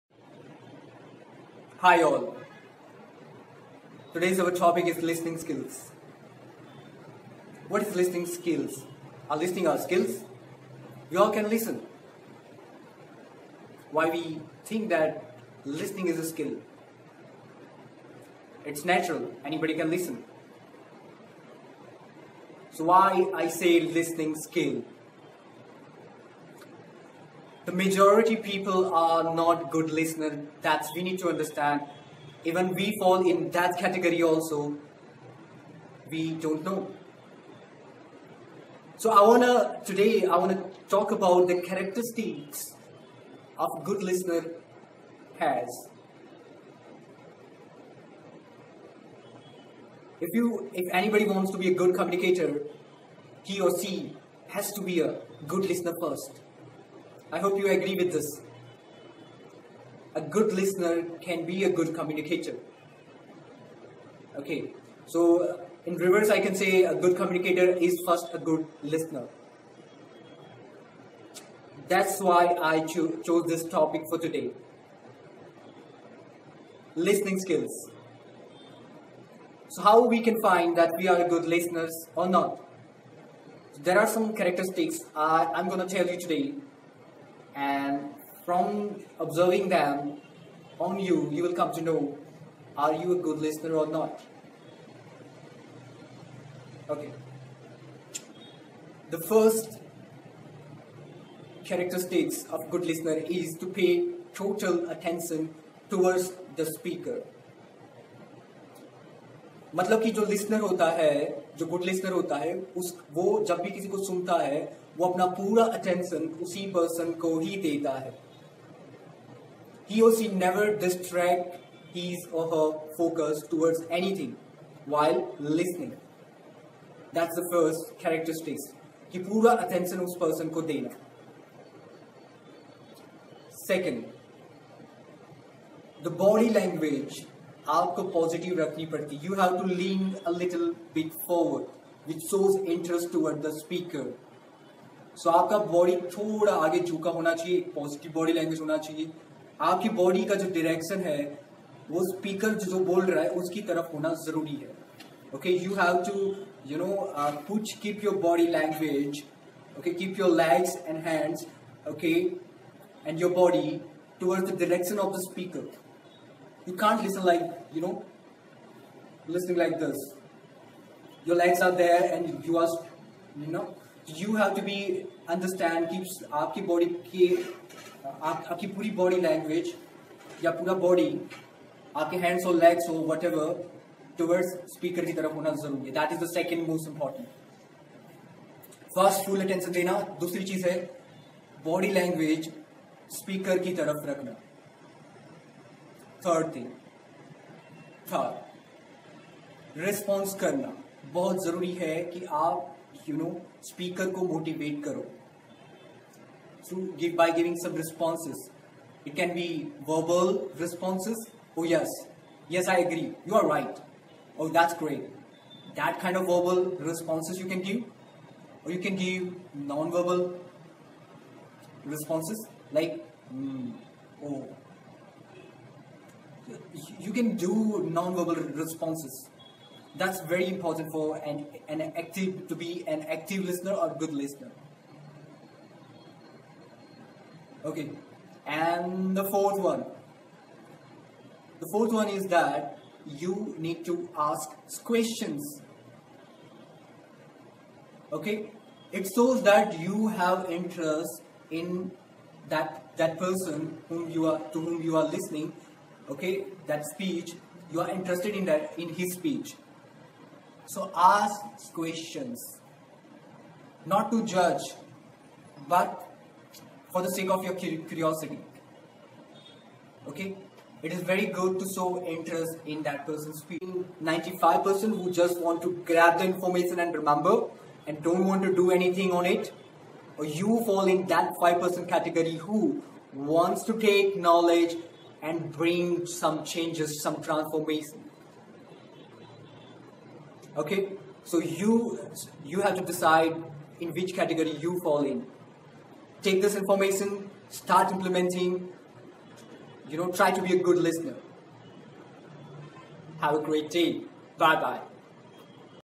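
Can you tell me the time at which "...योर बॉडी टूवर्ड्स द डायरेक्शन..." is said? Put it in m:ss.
2:43.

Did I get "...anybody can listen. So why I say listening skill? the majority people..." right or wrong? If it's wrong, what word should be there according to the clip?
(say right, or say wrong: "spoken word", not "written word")
right.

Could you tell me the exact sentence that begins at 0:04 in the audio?
Today's our topic is listening skills.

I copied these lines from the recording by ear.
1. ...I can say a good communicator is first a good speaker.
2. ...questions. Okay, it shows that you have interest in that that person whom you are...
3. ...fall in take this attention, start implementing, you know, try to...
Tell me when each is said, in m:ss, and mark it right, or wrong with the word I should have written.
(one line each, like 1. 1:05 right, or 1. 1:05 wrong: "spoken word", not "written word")
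1. 1:06 wrong: "listener", not "speaker"
2. 4:04 right
3. 4:54 wrong: "information", not "attention".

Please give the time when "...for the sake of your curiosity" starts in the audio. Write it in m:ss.
4:26.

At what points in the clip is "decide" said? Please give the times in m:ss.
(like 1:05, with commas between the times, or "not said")
4:52.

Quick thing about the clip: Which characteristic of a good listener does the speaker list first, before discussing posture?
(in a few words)
Pay total attention towards the speaker.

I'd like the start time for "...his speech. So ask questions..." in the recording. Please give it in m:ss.
4:18.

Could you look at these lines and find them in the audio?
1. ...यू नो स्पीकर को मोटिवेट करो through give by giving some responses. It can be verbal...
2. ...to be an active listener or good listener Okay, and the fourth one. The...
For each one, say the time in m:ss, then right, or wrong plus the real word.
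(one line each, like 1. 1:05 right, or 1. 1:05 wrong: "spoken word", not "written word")
1. 3:23 right
2. 3:52 right.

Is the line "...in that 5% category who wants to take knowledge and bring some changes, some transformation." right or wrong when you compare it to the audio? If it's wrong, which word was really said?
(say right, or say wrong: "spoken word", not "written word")
right.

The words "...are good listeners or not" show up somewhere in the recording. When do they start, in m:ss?
1:21.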